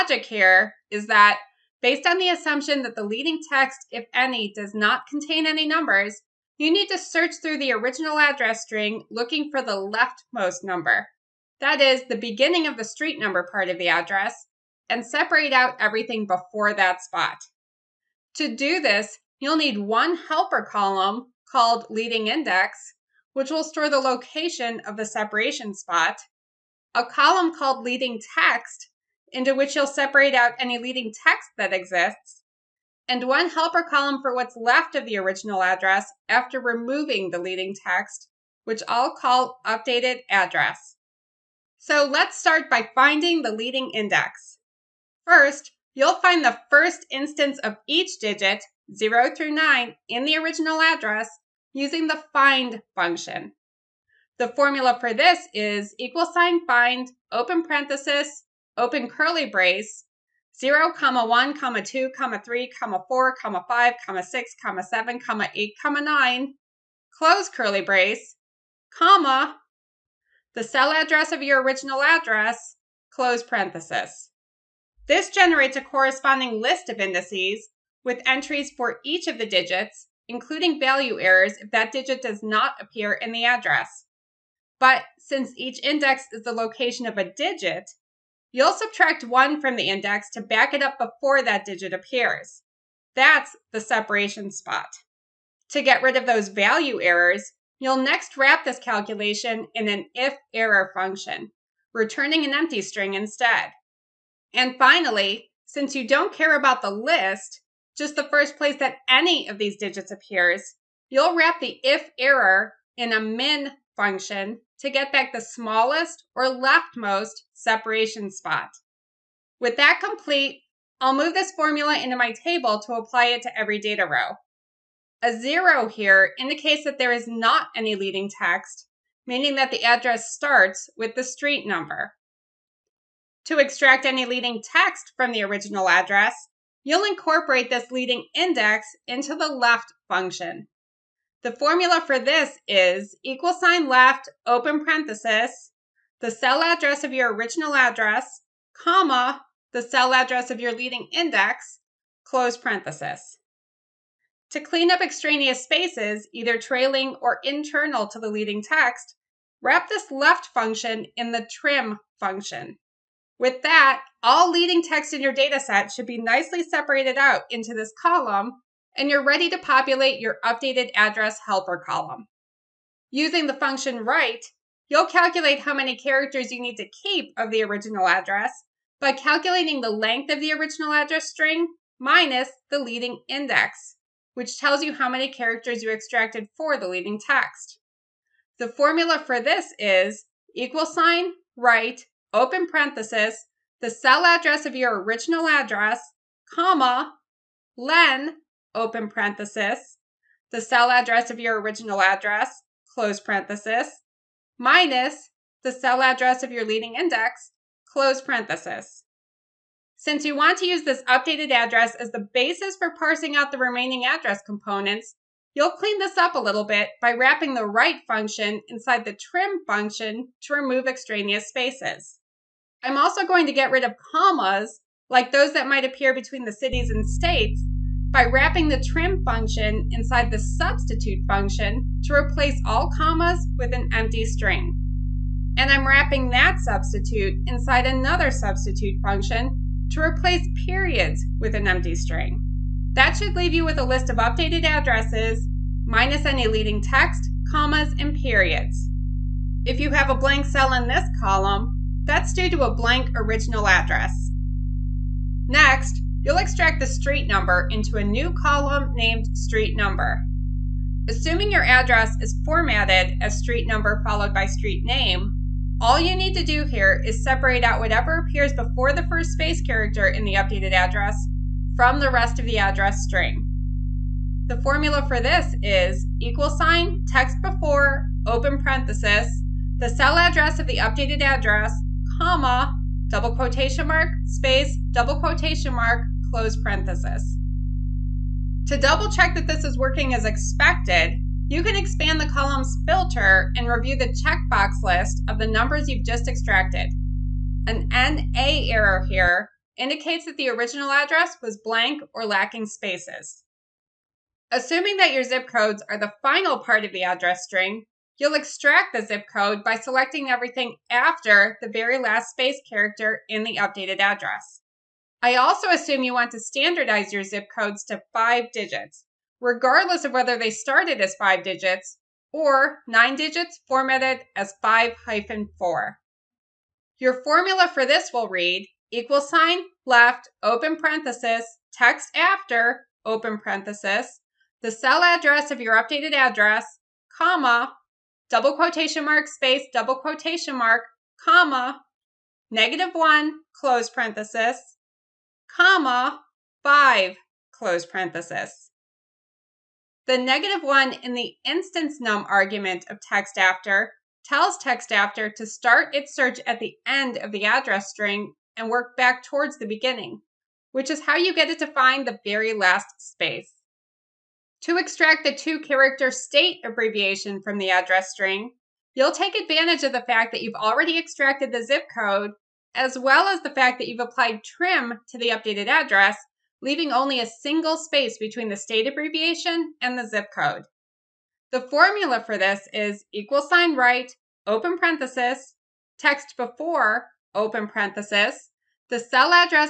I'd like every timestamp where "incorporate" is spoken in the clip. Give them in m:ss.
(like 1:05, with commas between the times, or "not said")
2:17.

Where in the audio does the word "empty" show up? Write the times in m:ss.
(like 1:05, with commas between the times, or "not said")
1:42, 3:53, 4:01.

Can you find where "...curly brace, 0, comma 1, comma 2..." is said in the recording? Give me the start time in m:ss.
0:59.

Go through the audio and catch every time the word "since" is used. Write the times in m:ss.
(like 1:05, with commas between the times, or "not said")
1:25, 1:45, 3:29.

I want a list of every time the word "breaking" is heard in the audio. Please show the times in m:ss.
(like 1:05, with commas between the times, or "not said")
not said.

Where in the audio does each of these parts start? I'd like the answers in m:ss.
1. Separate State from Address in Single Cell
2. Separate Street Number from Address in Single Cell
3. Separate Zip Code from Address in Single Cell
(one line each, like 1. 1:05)
1. 6:03
2. 4:14
3. 5:03.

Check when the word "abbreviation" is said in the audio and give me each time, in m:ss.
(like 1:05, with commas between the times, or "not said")
6:06, 6:18.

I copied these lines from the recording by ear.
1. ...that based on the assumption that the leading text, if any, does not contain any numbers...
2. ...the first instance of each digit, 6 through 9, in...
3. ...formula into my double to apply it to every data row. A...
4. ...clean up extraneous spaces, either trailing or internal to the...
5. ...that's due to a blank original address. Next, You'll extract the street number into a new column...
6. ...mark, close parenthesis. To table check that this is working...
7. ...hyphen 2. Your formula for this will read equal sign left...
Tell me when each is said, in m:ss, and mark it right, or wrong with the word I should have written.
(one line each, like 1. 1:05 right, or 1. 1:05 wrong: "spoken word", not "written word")
1. 0:01 right
2. 0:46 wrong: "0", not "6"
3. 2:01 wrong: "table", not "double"
4. 2:34 right
5. 4:12 right
6. 4:45 wrong: "double", not "table"
7. 5:25 wrong: "4", not "2".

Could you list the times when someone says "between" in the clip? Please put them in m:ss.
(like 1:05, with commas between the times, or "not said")
3:46, 6:18.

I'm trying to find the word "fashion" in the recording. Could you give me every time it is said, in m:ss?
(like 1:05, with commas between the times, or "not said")
not said.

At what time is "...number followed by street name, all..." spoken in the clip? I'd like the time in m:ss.
4:23.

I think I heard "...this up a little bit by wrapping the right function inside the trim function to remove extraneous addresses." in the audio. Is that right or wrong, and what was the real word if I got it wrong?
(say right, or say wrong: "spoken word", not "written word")
wrong: "spaces", not "addresses".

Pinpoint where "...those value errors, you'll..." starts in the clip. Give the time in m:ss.
1:36.